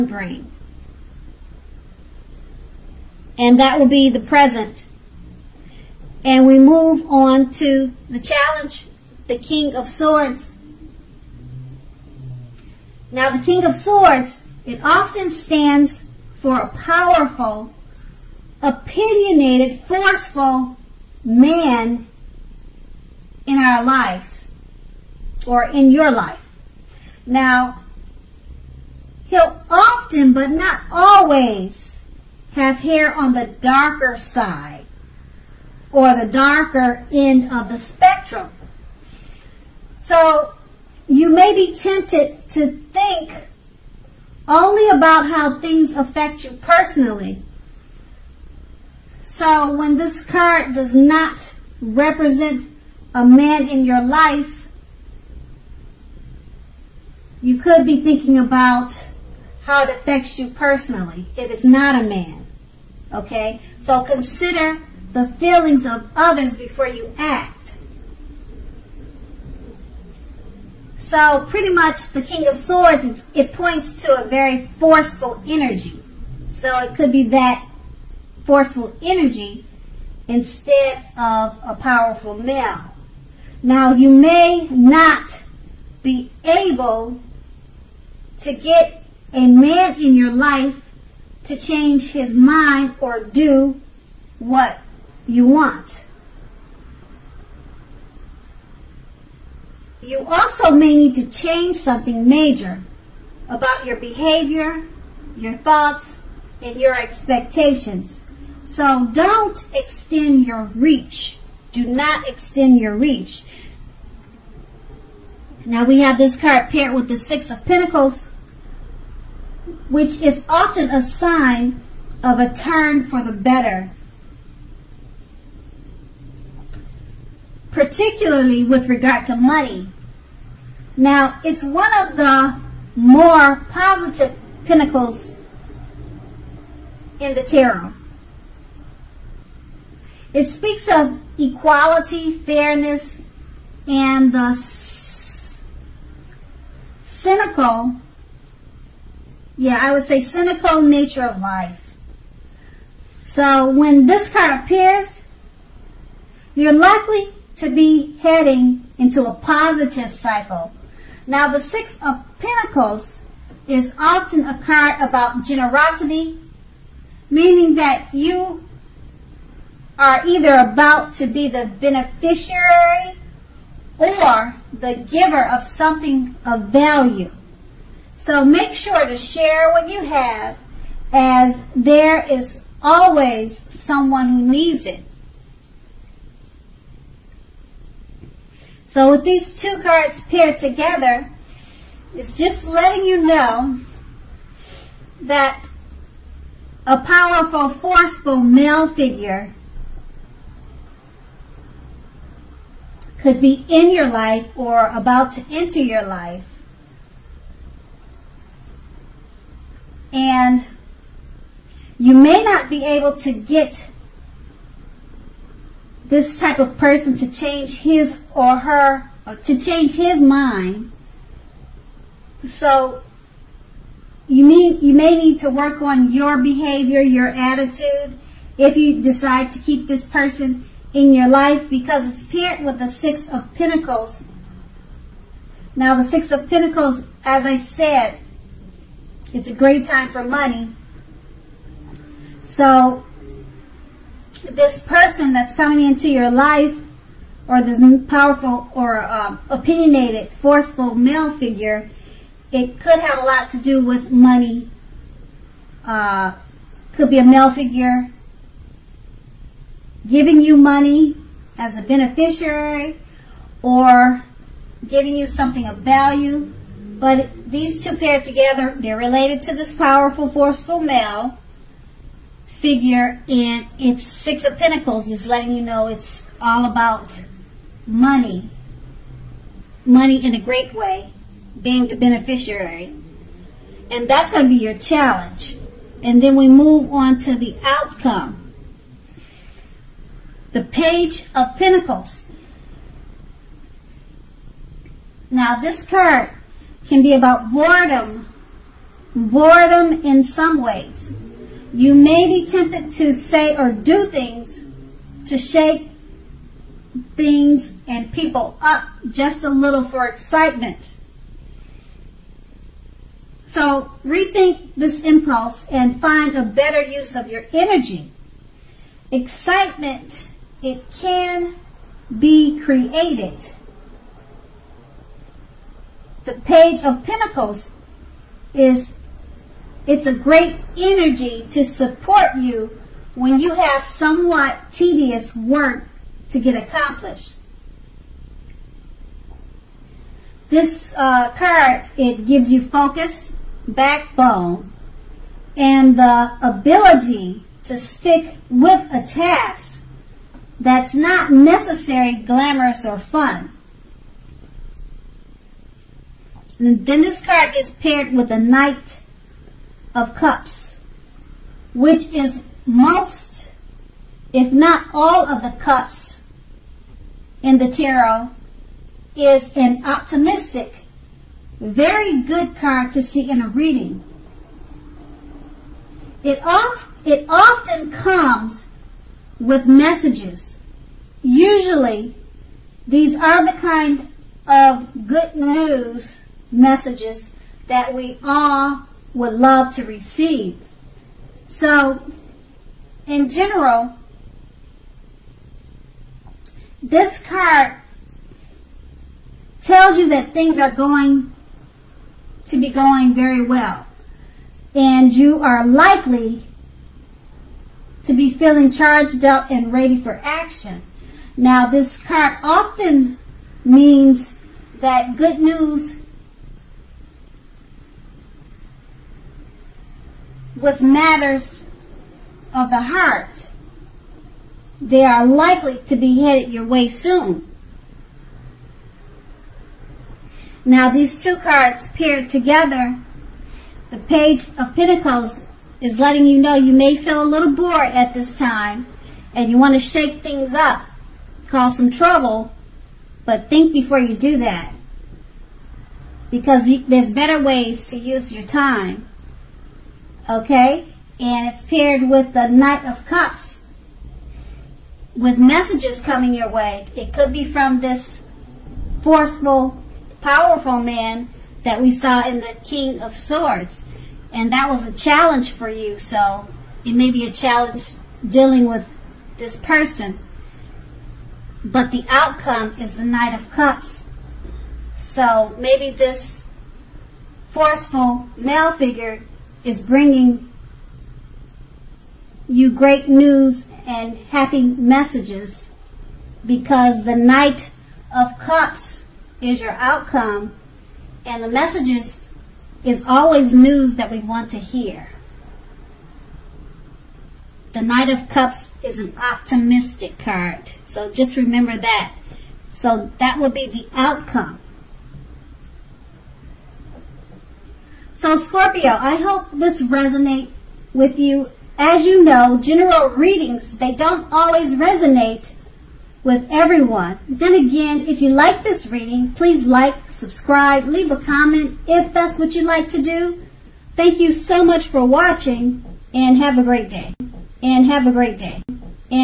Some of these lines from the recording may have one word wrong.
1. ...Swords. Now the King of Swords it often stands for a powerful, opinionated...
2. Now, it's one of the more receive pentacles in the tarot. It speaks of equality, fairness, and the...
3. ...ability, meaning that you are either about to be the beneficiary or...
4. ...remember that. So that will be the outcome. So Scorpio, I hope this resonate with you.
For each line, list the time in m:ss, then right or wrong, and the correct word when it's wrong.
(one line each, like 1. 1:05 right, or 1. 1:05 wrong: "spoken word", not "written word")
1. 0:09 right
2. 2:10 wrong: "positive", not "receive"
3. 2:45 wrong: "generosity", not "ability"
4. 8:21 right.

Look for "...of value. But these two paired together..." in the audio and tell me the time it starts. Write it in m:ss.
4:25.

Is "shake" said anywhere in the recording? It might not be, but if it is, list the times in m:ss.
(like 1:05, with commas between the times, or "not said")
5:05, 7:19.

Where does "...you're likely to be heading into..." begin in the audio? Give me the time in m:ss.
2:36.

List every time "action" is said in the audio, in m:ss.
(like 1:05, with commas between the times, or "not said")
6:50.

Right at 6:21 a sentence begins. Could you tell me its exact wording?
Usually, these are the kind of good news messages that we all would love to receive.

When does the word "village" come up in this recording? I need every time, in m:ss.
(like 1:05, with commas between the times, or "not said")
not said.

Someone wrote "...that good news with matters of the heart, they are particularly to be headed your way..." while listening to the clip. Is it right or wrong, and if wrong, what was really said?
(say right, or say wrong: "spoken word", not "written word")
wrong: "likely", not "particularly".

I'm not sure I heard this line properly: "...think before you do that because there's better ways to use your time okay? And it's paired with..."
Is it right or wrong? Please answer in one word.
right.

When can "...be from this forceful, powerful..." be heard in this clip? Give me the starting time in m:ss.
7:37.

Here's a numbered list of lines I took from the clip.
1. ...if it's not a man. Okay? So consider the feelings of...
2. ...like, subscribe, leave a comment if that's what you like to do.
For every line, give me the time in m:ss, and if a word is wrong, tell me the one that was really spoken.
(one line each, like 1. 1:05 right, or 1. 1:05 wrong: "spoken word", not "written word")
1. 1:01 right
2. 8:39 right.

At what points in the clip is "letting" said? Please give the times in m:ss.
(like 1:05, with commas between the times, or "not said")
3:12, 4:35, 7:15.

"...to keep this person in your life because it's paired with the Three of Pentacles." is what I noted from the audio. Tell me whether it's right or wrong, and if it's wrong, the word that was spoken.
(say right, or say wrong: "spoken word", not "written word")
wrong: "Six", not "Three".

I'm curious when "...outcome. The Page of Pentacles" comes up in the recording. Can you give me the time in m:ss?
4:47.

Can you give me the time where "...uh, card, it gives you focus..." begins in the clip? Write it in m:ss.
5:40.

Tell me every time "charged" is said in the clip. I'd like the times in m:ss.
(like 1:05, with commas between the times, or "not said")
6:48.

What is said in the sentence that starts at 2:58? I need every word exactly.
So make sure to share what you have as there is always someone who needs it.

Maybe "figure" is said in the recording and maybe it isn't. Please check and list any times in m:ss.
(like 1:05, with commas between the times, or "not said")
3:18, 4:11, 4:17, 4:32, 7:58.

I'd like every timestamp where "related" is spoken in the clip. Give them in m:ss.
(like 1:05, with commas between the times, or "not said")
4:28.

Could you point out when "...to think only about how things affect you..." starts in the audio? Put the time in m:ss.
0:42.